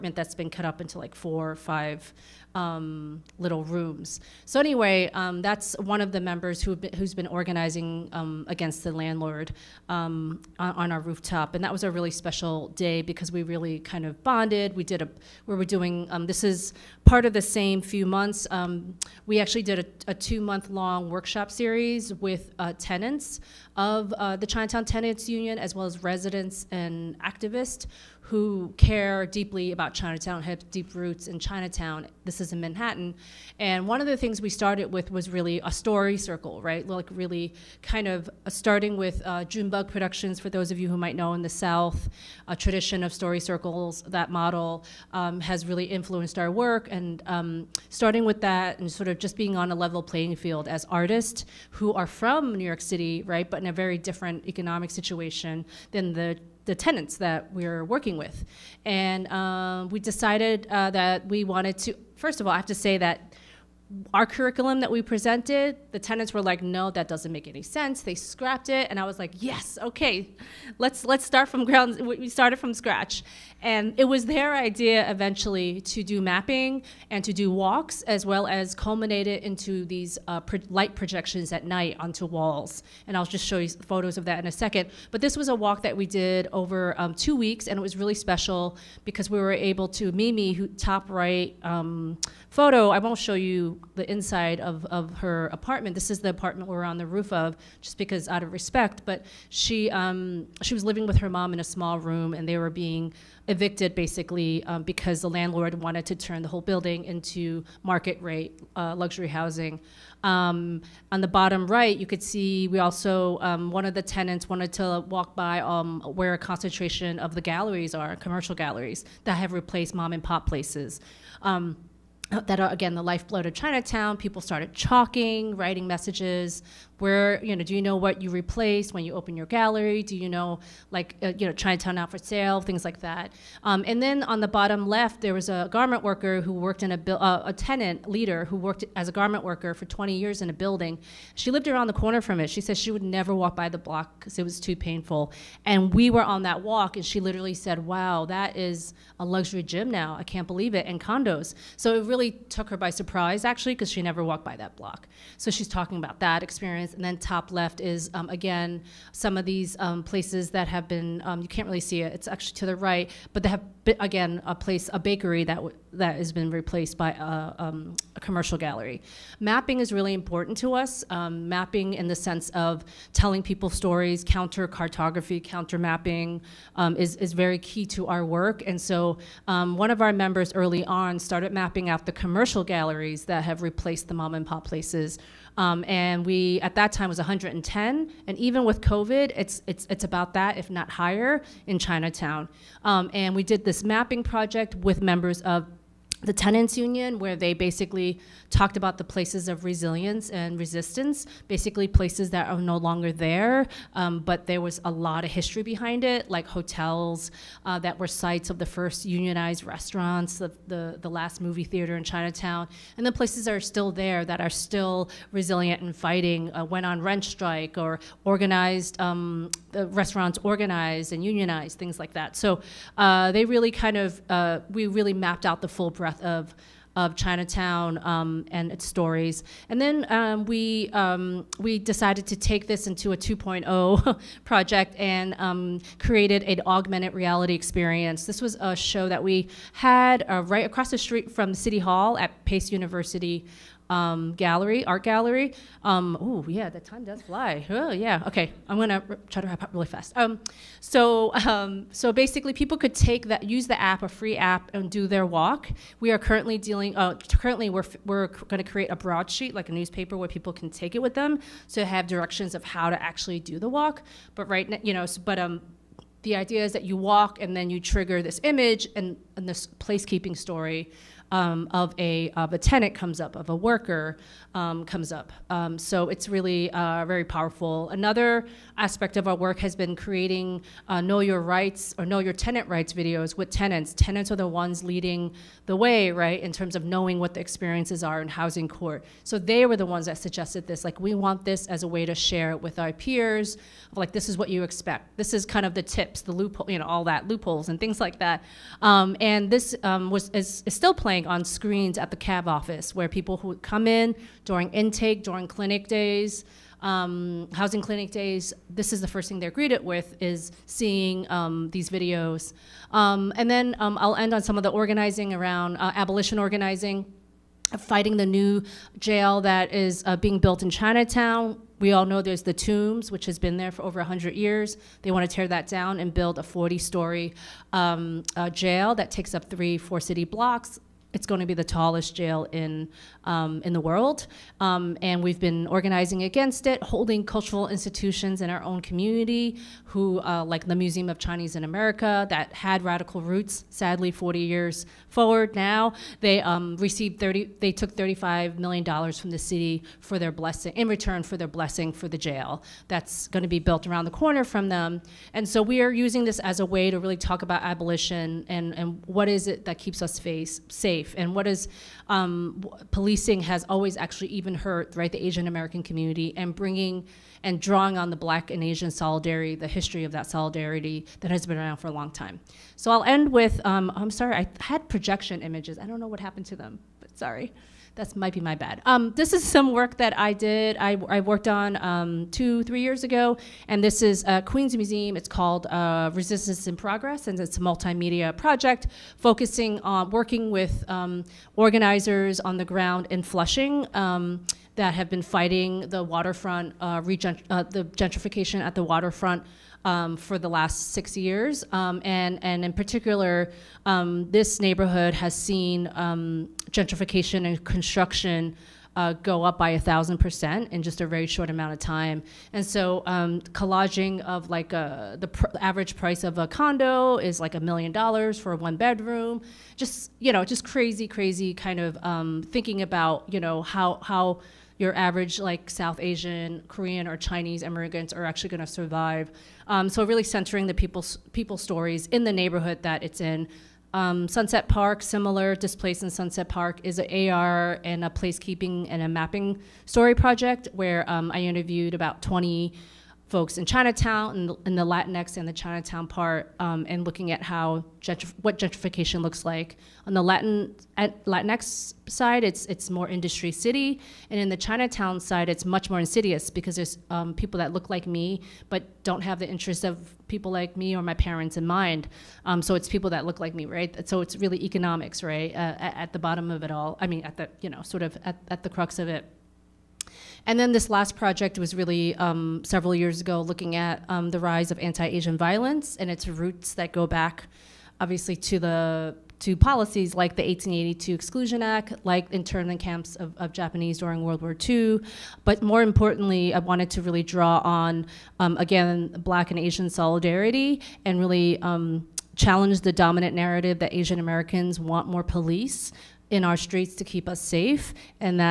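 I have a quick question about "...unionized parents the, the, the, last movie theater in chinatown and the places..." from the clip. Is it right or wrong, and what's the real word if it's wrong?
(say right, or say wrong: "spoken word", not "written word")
wrong: "restaurants", not "parents".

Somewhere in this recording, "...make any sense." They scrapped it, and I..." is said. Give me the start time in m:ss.
1:07.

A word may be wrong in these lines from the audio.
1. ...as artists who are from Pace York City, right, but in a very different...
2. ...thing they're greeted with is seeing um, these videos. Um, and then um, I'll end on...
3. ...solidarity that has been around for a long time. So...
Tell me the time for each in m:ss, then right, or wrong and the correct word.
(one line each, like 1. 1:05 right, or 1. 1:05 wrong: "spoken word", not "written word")
1. 0:50 wrong: "New", not "Pace"
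2. 5:09 right
3. 6:10 right.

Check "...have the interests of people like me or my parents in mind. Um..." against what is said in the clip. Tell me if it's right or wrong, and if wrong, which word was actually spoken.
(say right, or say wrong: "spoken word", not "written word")
right.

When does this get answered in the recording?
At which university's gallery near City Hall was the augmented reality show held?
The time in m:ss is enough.
4:02.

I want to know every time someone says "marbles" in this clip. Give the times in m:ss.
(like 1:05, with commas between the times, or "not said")
not said.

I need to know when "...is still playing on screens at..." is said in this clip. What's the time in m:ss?
5:00.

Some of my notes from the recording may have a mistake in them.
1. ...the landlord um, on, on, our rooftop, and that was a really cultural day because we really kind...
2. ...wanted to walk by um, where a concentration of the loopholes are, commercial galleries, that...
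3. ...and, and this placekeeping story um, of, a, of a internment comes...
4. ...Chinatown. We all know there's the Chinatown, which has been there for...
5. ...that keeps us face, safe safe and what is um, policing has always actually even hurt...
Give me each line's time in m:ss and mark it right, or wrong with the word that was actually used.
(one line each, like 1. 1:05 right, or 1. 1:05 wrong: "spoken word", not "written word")
1. 0:08 wrong: "special", not "cultural"
2. 1:54 wrong: "galleries", not "loopholes"
3. 4:28 wrong: "tenant", not "internment"
4. 5:20 wrong: "Tombs", not "Chinatown"
5. 5:59 right.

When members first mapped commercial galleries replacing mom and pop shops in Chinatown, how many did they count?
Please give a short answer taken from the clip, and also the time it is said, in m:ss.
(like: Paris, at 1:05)
110, at 3:07.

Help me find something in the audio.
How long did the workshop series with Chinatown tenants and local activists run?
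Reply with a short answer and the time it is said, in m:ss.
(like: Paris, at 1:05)
2 months, at 0:20.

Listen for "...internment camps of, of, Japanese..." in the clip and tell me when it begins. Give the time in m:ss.
8:02.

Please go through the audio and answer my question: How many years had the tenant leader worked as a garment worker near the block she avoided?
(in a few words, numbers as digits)
20 years.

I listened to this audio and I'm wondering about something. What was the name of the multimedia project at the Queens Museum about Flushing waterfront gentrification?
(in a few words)
Resistance in Progress.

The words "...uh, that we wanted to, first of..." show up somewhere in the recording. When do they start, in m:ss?
1:00.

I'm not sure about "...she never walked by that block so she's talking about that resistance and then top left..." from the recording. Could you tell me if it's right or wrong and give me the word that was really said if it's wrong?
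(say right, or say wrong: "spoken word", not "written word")
wrong: "experience", not "resistance".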